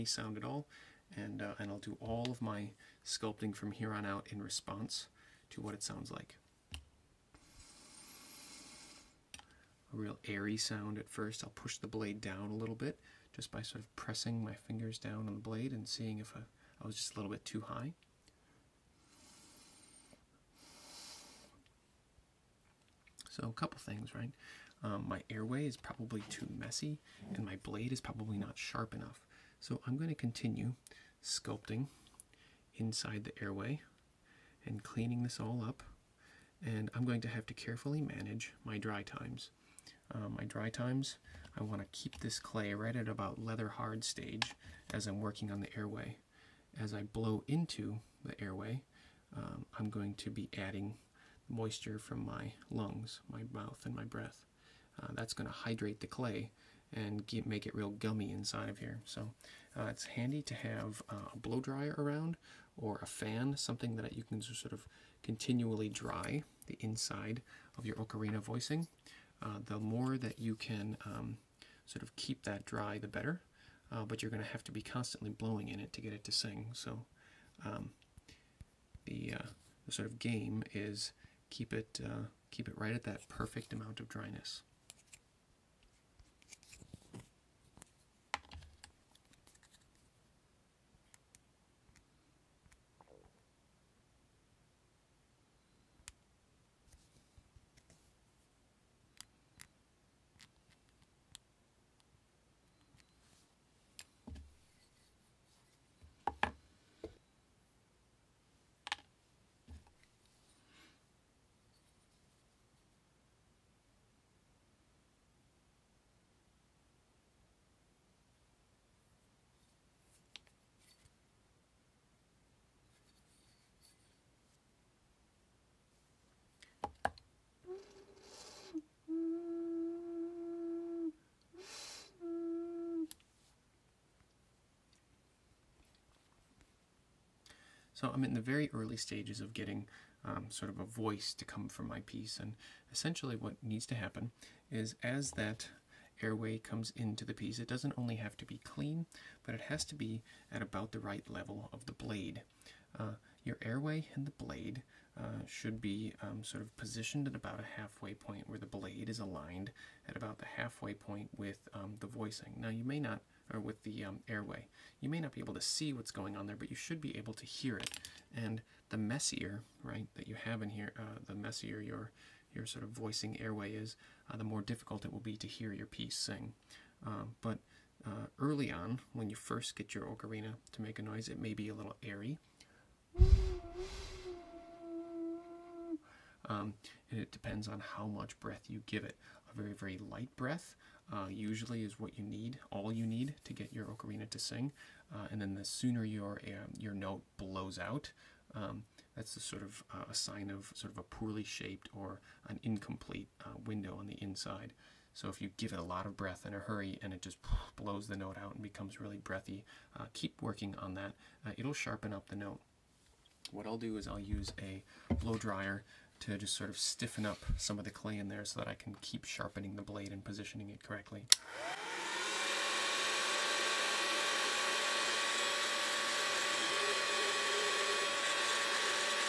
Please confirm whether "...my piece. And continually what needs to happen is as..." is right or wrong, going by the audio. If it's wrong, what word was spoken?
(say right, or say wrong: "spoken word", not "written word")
wrong: "essentially", not "continually".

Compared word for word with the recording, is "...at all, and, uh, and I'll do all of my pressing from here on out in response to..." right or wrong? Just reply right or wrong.
wrong.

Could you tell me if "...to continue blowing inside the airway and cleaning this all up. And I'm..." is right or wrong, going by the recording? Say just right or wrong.
wrong.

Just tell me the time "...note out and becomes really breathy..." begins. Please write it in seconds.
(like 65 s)
208 s.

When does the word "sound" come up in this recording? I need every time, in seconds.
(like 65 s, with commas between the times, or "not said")
0 s, 5 s, 10 s.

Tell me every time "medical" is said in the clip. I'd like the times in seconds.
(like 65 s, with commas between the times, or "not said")
not said.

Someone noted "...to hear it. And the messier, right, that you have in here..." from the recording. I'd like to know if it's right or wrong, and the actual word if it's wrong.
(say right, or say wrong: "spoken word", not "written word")
right.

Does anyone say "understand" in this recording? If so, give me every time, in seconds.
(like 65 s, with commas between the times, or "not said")
not said.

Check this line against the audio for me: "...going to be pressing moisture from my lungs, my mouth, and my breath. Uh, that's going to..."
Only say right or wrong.
wrong.